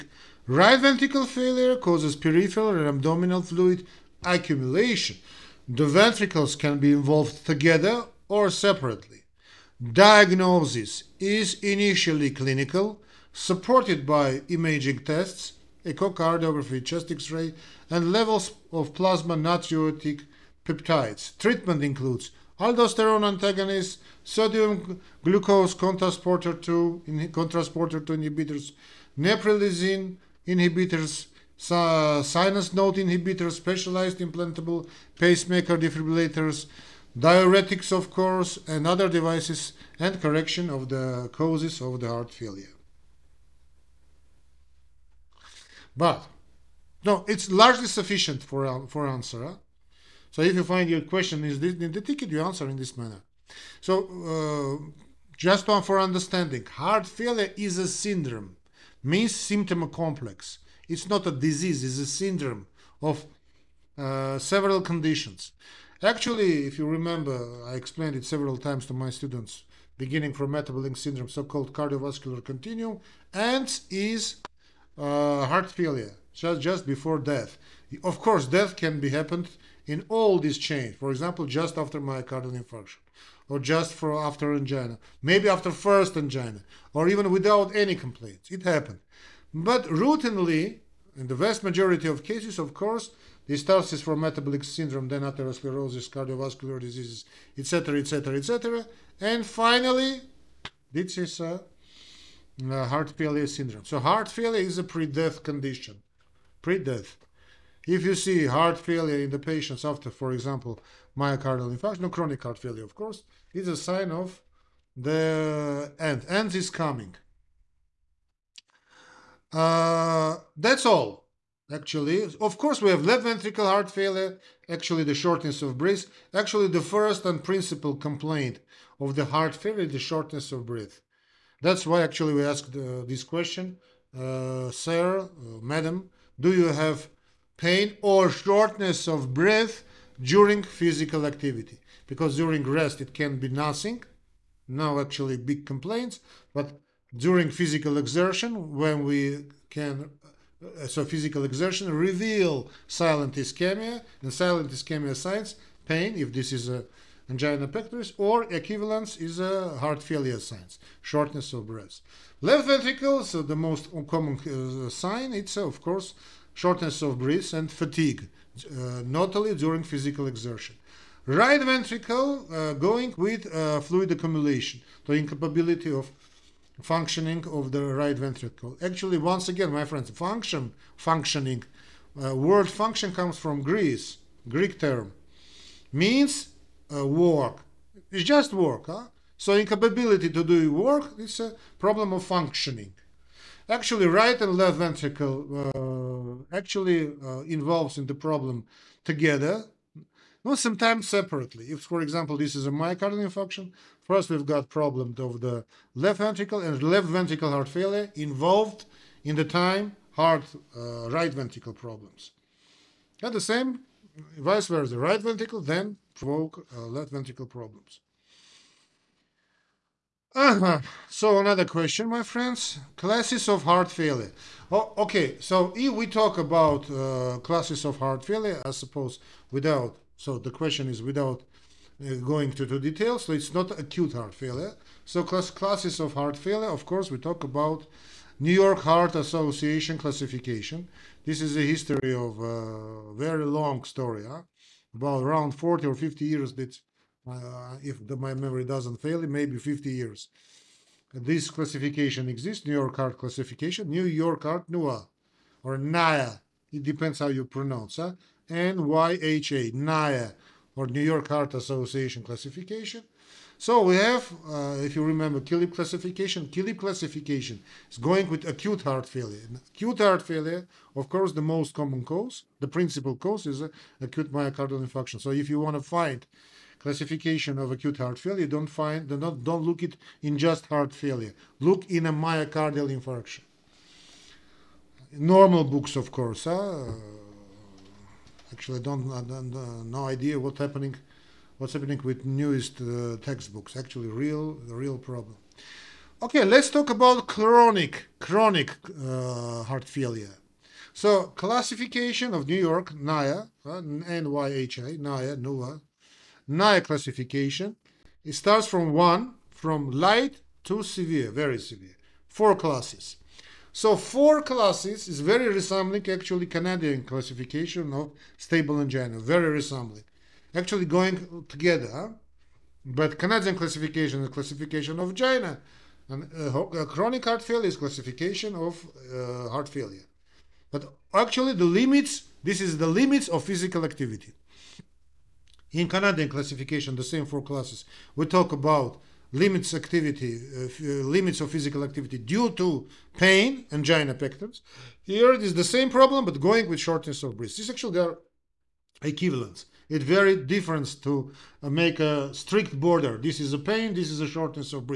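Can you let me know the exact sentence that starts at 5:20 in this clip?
Actually going together, but Canadian classification is classification of angina, and uh, uh, chronic heart failure is classification of uh, heart failure.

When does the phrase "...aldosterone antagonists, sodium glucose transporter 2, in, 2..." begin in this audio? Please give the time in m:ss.
0:22.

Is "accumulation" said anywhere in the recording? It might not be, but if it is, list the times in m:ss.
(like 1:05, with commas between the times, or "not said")
0:04, 2:54.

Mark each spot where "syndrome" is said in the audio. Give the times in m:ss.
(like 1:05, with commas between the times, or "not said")
0:57, 1:02, 1:10, 1:34, 1:43.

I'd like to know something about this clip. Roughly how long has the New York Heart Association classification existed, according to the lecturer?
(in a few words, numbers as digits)
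50 years.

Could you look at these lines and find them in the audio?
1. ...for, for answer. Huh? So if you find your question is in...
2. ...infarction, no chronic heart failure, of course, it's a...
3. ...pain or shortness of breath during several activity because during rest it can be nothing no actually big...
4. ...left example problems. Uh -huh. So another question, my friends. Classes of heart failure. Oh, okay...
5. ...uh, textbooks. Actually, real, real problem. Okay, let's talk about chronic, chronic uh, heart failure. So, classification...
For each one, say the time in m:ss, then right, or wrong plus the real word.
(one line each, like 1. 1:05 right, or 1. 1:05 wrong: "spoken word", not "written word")
1. 0:48 right
2. 1:51 right
3. 2:17 wrong: "physical", not "several"
4. 3:36 wrong: "ventricle", not "example"
5. 4:52 right.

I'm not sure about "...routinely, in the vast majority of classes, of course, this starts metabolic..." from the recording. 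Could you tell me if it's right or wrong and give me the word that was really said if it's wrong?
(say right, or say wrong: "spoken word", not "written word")
wrong: "cases", not "classes".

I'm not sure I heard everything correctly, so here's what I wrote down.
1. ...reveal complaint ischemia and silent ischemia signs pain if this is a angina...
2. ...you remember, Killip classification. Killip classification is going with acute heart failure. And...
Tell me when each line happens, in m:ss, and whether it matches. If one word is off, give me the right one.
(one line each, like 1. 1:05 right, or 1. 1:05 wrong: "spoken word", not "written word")
1. 2:31 wrong: "silent", not "complaint"
2. 4:24 right.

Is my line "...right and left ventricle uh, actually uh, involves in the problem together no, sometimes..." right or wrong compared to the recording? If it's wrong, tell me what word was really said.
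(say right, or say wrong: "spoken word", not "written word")
right.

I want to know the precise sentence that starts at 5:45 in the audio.
Here it is the same problem, but going with shortness of breath.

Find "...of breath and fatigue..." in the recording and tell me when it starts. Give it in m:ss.
2:47.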